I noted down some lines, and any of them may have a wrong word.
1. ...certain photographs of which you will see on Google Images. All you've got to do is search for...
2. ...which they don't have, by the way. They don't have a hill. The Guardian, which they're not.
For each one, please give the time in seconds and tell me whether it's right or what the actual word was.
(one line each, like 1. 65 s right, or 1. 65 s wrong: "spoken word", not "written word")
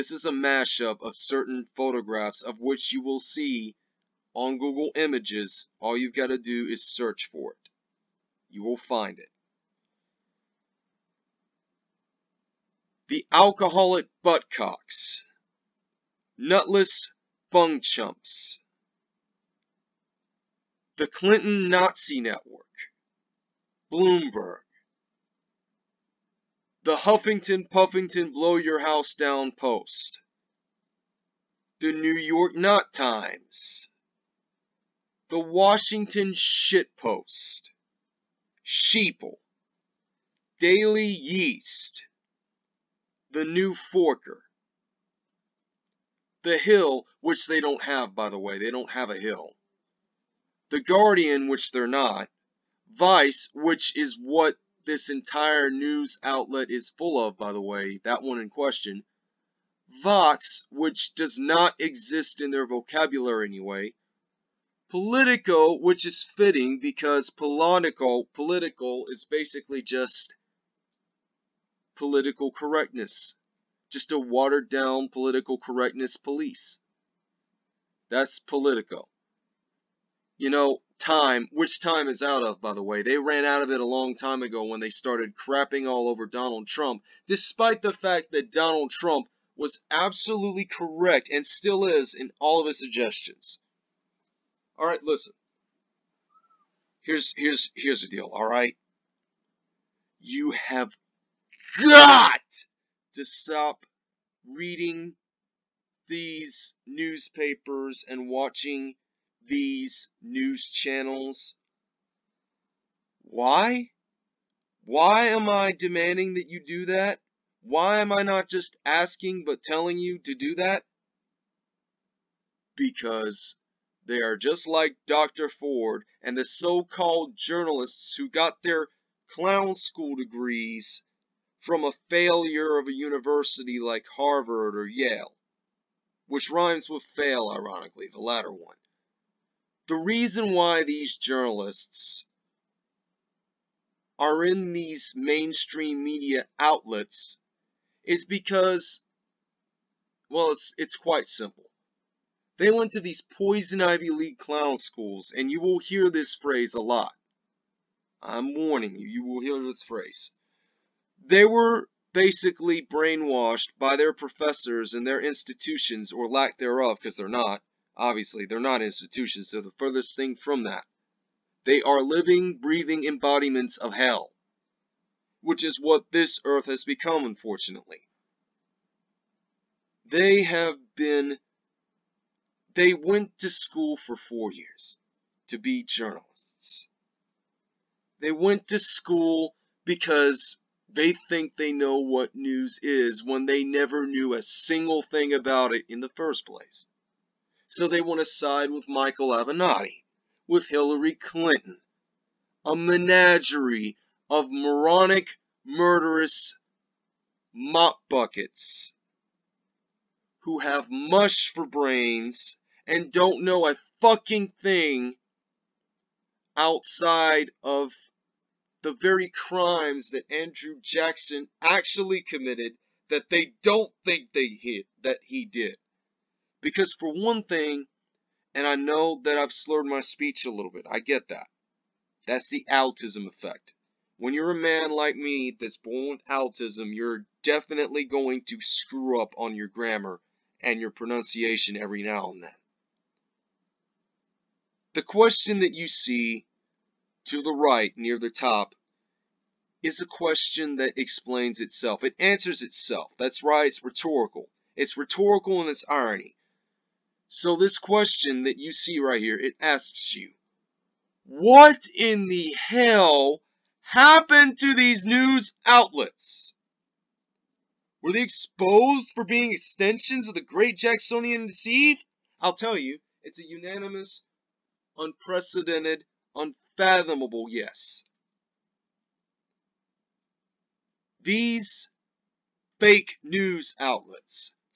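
1. 1 s right
2. 47 s right.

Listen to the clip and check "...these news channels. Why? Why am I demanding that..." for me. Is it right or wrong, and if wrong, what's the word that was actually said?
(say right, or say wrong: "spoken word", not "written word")
right.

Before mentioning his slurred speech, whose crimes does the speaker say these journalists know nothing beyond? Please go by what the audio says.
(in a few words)
Andrew Jackson.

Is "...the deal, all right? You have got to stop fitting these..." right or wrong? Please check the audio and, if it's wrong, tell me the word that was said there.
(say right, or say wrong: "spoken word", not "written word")
wrong: "reading", not "fitting".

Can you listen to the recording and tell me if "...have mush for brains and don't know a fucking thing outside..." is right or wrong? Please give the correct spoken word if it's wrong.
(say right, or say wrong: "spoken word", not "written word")
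right.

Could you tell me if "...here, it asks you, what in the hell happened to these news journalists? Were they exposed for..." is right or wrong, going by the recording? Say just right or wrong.
wrong.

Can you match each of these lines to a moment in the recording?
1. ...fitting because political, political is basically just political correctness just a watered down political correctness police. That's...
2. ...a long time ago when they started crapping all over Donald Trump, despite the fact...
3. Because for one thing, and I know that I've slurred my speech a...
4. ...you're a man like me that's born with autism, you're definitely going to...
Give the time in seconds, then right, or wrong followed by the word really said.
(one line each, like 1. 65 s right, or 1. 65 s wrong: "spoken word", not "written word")
1. 66 s right
2. 83 s right
3. 226 s right
4. 234 s right.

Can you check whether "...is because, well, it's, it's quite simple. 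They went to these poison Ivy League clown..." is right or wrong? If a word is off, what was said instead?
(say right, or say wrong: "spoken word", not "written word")
right.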